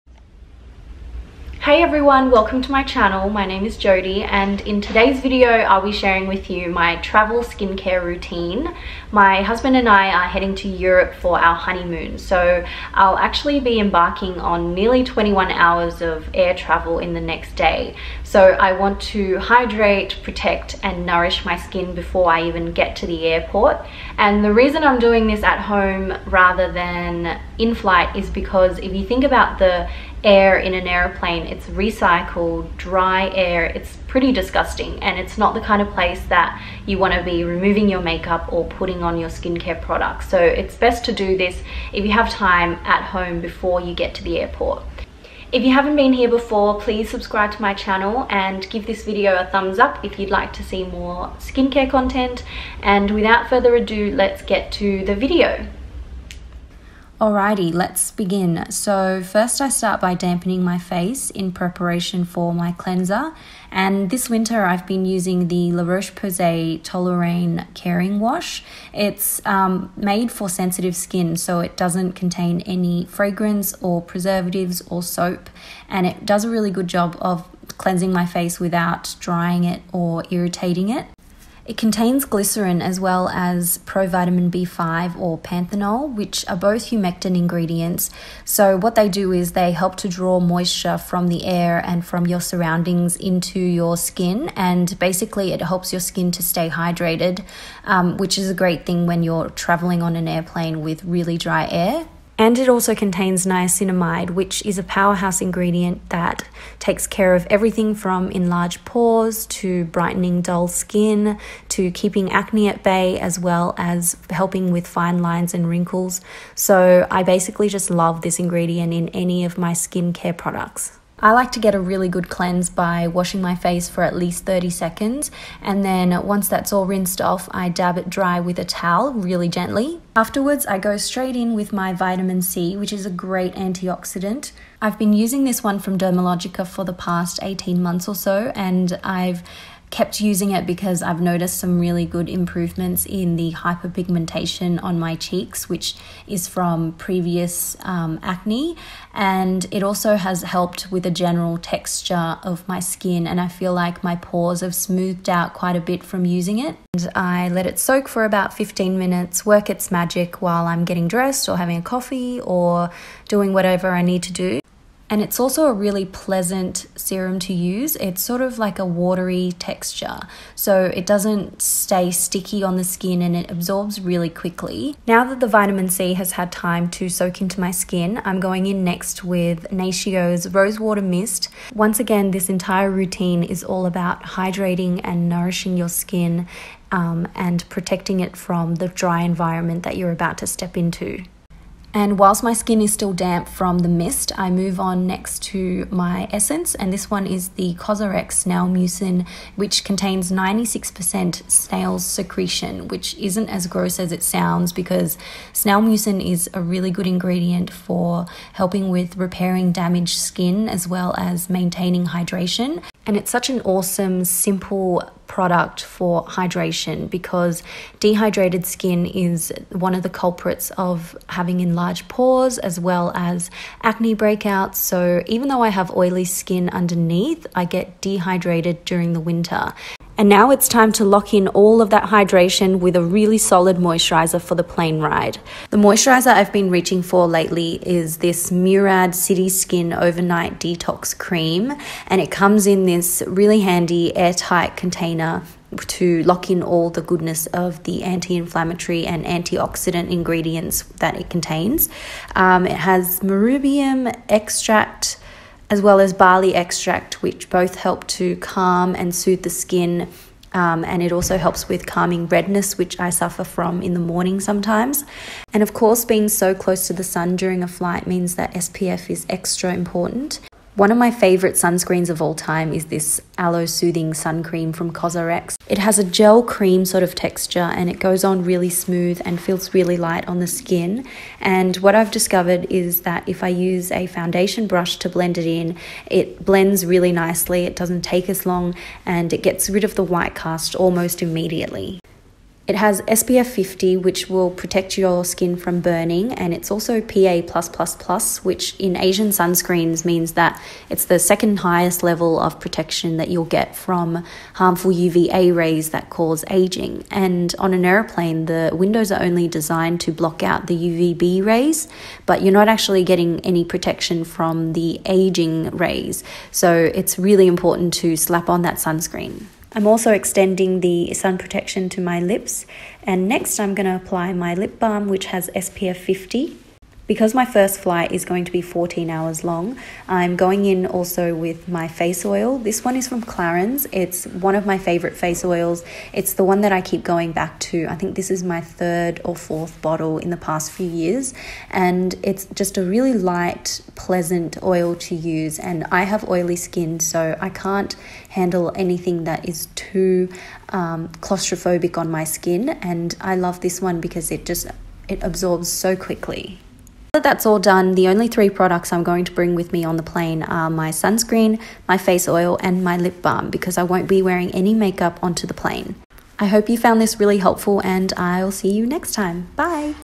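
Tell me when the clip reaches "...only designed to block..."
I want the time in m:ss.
5:09.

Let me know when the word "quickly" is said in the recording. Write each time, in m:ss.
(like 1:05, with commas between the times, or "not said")
2:54, 5:55.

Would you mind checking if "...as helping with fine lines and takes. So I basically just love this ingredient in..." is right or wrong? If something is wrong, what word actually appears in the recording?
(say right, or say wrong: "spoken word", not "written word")
wrong: "wrinkles", not "takes".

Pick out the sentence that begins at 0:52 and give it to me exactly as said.
And without further ado, let's get to the video.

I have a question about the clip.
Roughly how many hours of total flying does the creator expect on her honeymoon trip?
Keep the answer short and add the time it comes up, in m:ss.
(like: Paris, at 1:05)
21, at 0:15.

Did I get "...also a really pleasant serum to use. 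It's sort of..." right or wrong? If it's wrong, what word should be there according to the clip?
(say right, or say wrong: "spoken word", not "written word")
right.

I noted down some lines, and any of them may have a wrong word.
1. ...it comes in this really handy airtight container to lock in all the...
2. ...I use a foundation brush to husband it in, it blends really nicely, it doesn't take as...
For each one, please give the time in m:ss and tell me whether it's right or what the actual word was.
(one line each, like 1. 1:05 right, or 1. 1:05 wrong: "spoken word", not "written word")
1. 4:02 right
2. 4:43 wrong: "blend", not "husband".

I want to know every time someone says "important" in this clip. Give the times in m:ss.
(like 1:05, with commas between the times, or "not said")
4:29, 5:17.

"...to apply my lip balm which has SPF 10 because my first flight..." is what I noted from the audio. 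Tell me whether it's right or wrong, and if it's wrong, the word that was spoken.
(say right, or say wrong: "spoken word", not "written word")
wrong: "50", not "10".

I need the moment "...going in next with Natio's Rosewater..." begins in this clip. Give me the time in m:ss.
2:58.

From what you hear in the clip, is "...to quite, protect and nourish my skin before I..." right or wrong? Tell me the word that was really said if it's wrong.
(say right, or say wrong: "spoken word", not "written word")
wrong: "hydrate", not "quite".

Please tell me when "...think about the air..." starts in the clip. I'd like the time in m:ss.
0:29.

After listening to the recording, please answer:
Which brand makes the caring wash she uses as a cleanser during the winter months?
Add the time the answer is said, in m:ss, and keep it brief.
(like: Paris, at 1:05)
La Roche Posay, at 1:05.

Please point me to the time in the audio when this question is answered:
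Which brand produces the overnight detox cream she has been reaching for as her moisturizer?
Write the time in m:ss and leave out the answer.
3:58.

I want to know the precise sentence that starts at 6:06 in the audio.
I hope you found this really helpful and I'll see you next time.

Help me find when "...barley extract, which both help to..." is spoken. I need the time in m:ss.
4:16.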